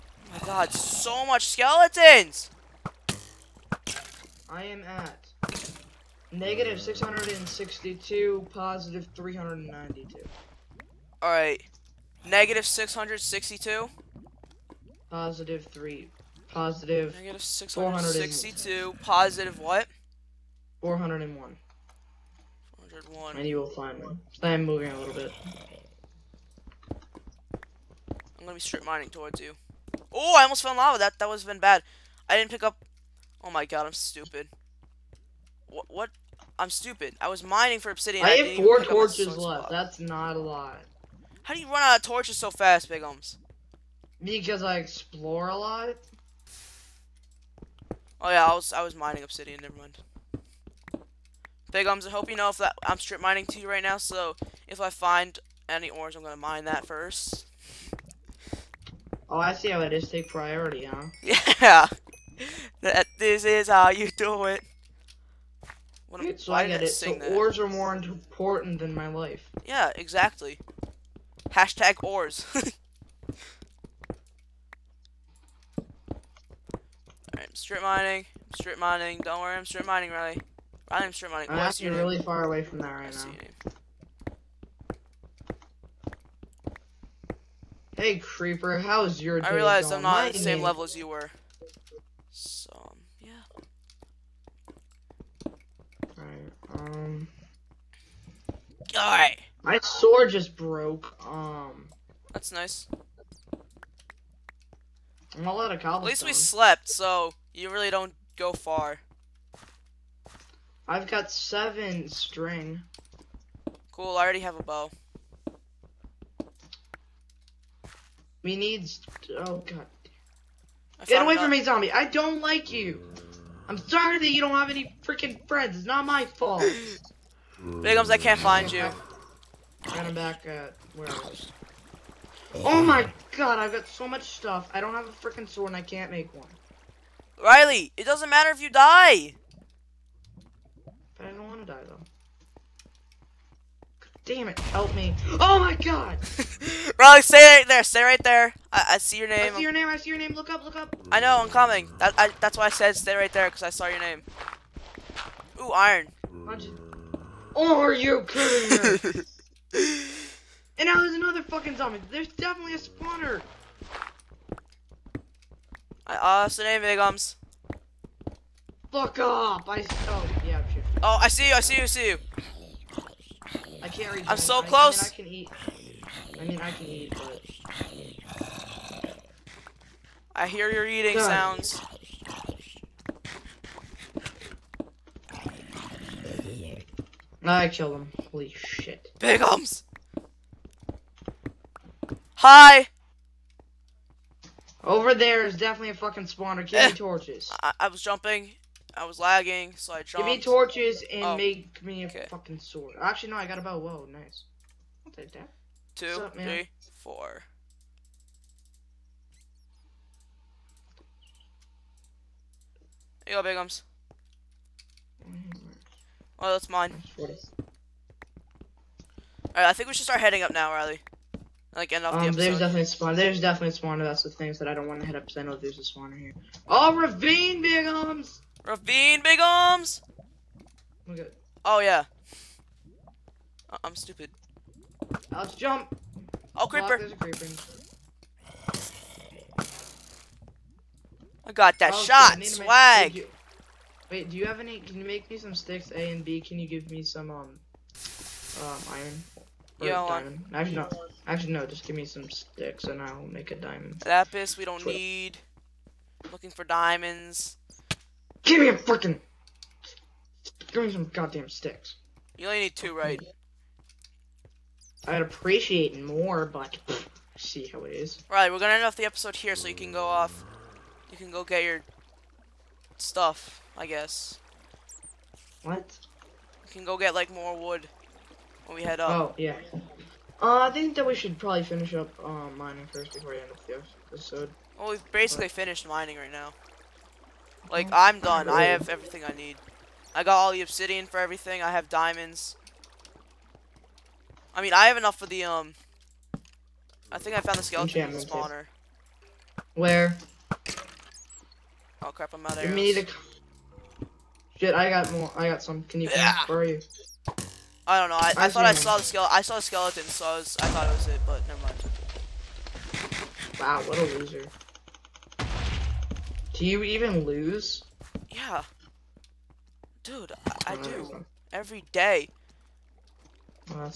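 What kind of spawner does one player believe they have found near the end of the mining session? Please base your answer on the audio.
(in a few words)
Skeleton spawner.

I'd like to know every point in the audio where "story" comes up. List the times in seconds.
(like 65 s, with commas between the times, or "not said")
not said.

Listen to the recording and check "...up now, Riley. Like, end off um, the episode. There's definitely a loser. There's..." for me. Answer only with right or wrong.
wrong.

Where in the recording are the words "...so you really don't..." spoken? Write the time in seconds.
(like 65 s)
106 s.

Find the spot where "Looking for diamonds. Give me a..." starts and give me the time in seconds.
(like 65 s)
256 s.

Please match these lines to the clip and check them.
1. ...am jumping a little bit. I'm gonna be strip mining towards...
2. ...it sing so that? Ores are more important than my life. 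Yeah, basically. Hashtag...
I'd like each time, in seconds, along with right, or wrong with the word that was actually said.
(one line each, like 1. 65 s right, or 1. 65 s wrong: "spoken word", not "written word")
1. 24 s wrong: "moving", not "jumping"
2. 66 s wrong: "exactly", not "basically".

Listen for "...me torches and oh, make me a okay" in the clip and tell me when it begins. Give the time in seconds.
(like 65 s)
200 s.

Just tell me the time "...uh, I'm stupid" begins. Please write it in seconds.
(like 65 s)
233 s.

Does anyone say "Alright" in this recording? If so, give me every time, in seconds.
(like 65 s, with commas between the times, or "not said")
11 s, 72 s, 98 s, 217 s.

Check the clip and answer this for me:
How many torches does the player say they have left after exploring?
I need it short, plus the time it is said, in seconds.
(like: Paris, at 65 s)
4, at 38 s.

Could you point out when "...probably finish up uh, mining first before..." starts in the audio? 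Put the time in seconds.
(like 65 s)
281 s.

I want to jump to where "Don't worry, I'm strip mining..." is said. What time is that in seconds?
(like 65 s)
79 s.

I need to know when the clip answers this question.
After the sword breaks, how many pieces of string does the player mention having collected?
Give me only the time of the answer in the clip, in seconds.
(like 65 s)
111 s.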